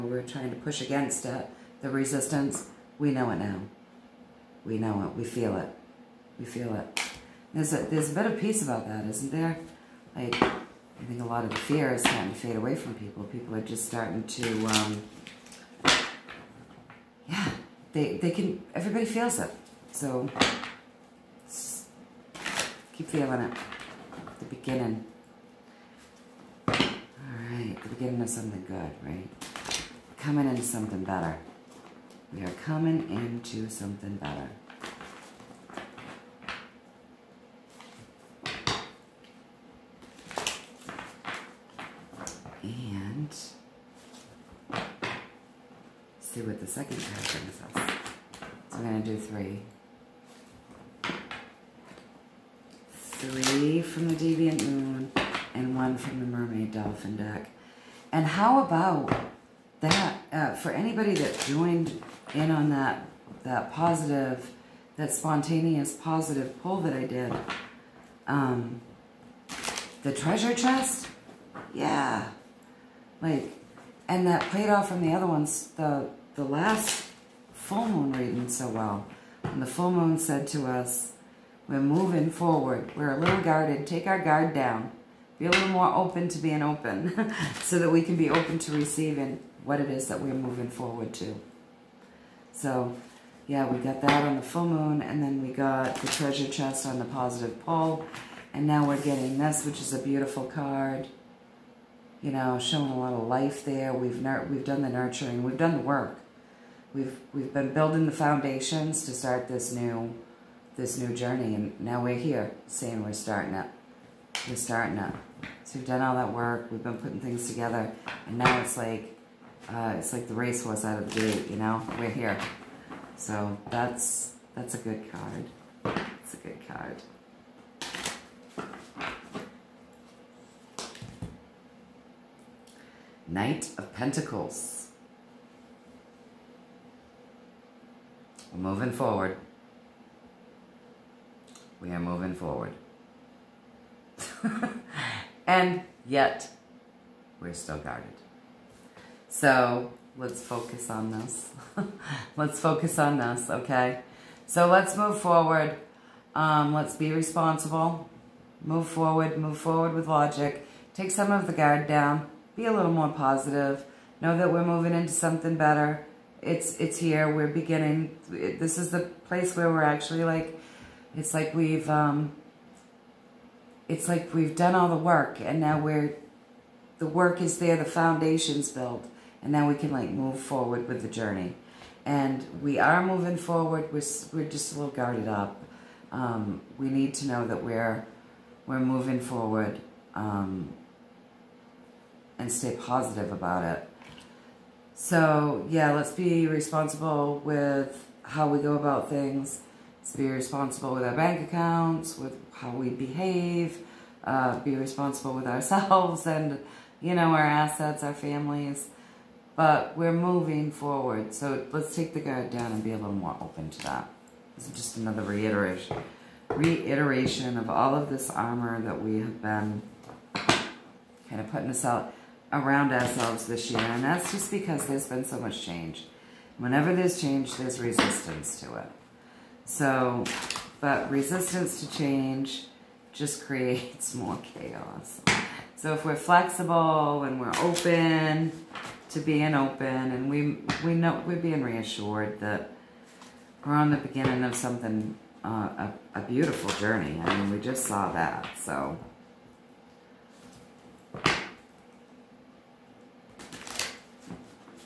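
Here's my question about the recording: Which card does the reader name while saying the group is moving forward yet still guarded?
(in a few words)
Knight of Pentacles.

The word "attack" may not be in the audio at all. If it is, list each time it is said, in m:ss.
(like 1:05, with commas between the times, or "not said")
not said.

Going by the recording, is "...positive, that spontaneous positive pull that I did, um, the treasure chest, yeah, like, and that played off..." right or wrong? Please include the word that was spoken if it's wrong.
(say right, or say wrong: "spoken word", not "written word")
right.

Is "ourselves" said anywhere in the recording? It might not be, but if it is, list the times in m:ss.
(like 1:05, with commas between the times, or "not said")
3:25, 3:42.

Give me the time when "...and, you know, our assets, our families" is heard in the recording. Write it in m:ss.
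3:26.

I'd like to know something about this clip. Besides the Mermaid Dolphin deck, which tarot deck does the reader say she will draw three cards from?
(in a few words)
Deviant Moon.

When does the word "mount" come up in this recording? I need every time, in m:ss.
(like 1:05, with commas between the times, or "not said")
not said.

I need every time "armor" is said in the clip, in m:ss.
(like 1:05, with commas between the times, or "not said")
3:38.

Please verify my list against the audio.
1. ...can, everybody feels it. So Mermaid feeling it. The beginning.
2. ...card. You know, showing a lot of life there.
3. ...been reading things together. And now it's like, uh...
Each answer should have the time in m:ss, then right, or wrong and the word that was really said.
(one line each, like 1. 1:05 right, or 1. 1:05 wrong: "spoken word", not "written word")
1. 0:18 wrong: "Keep", not "Mermaid"
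2. 1:40 right
3. 1:56 wrong: "putting", not "reading".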